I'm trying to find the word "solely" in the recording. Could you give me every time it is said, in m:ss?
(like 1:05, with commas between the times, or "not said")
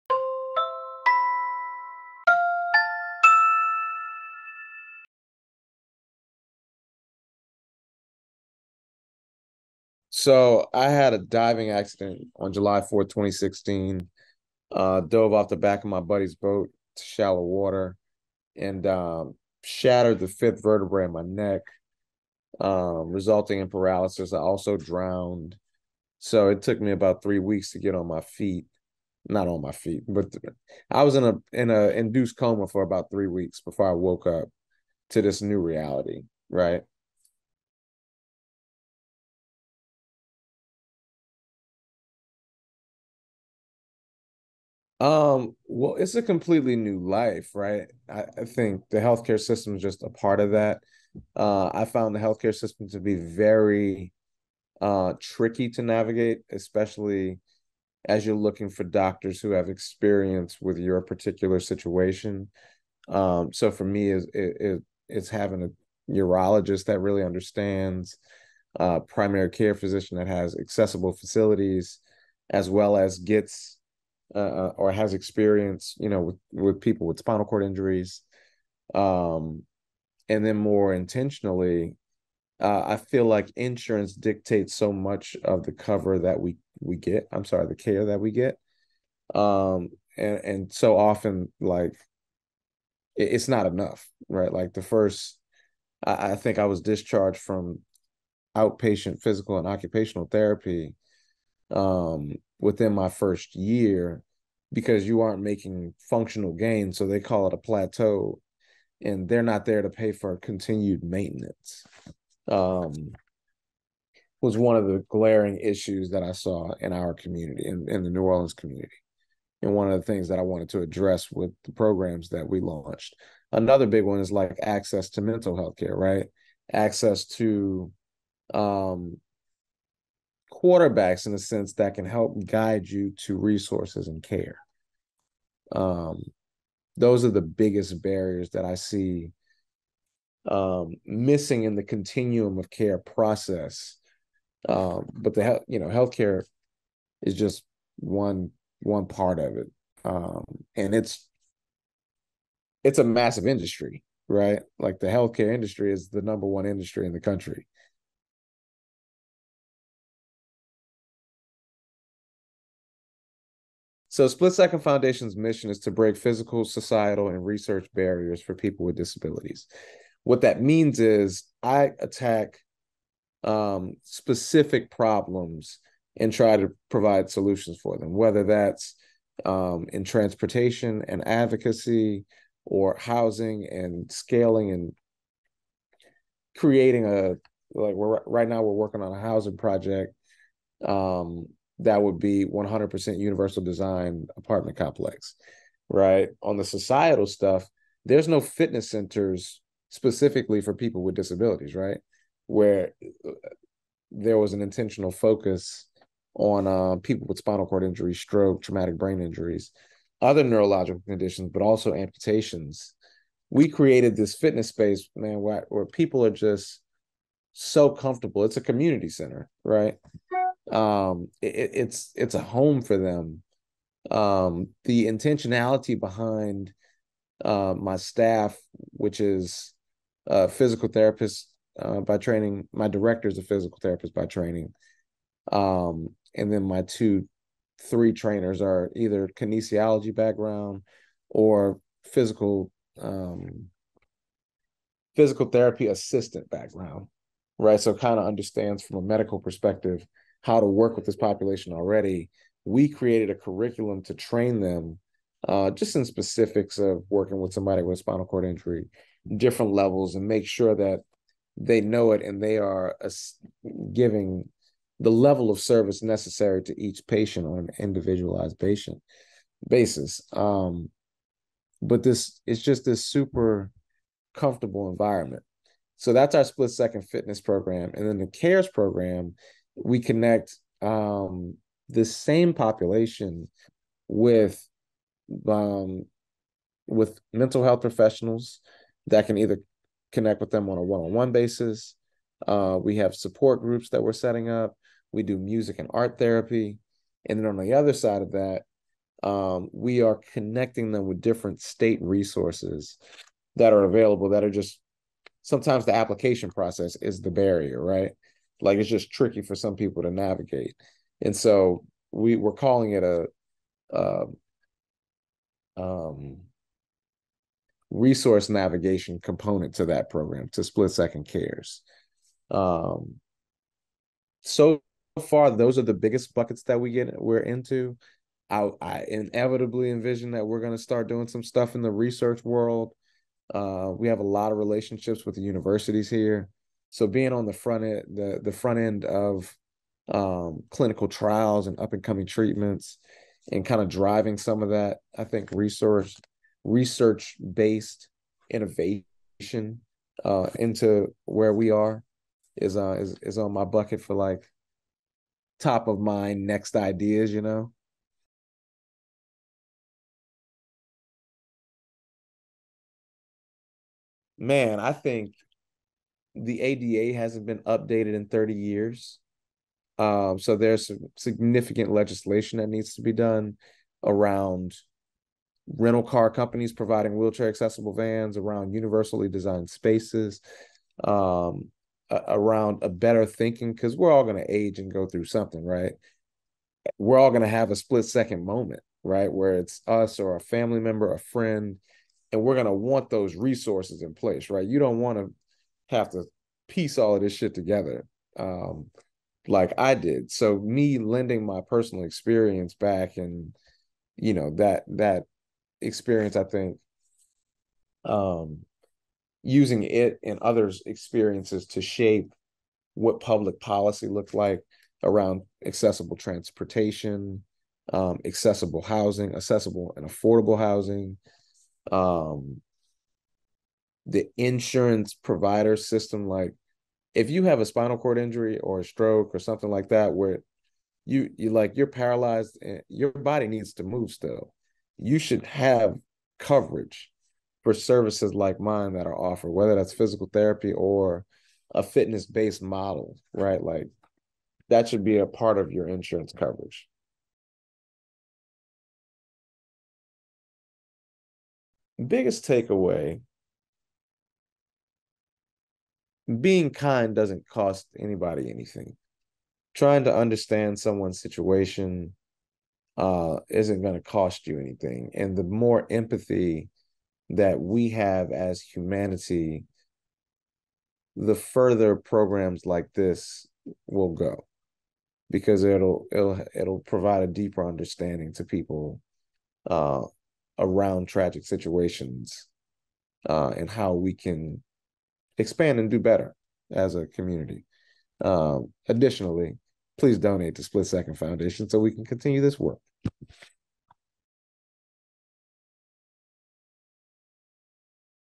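not said.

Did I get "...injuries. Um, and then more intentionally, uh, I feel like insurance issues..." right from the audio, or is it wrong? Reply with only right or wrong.
wrong.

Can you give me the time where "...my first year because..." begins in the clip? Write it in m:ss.
1:42.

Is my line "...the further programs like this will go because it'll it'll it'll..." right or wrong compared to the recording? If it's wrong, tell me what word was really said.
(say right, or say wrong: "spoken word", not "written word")
right.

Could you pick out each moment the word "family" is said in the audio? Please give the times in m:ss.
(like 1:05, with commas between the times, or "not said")
6:30.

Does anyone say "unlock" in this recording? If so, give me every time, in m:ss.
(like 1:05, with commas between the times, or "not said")
not said.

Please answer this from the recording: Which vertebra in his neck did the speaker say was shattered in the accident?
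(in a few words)
Fifth.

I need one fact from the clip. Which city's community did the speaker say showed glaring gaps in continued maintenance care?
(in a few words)
New Orleans.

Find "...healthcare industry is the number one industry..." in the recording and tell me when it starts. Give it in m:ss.
2:35.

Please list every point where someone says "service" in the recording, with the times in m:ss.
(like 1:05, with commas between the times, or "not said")
4:25, 7:17.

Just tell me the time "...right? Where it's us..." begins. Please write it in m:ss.
6:29.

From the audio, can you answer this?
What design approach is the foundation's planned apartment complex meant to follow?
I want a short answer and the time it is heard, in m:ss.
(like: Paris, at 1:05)
100% universal design, at 3:12.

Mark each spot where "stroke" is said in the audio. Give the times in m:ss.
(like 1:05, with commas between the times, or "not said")
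3:28, 7:08.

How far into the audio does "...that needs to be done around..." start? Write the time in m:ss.
6:12.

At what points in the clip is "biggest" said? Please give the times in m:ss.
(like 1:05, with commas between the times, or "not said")
2:17, 5:25, 7:32.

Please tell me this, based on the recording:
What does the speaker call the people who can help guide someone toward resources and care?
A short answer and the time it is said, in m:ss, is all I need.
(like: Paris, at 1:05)
Quarterbacks, at 2:10.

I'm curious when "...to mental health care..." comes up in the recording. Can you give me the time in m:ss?
2:05.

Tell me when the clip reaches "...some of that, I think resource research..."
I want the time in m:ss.
5:44.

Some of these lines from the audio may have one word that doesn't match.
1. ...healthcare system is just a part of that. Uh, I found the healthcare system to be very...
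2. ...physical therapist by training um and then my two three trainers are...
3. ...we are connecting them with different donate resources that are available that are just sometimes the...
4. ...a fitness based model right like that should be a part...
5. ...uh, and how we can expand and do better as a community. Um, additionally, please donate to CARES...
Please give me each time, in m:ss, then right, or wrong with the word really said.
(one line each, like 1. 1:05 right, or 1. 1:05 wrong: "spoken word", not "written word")
1. 0:48 right
2. 3:53 right
3. 4:59 wrong: "state", not "donate"
4. 7:21 right
5. 8:03 wrong: "Split", not "CARES".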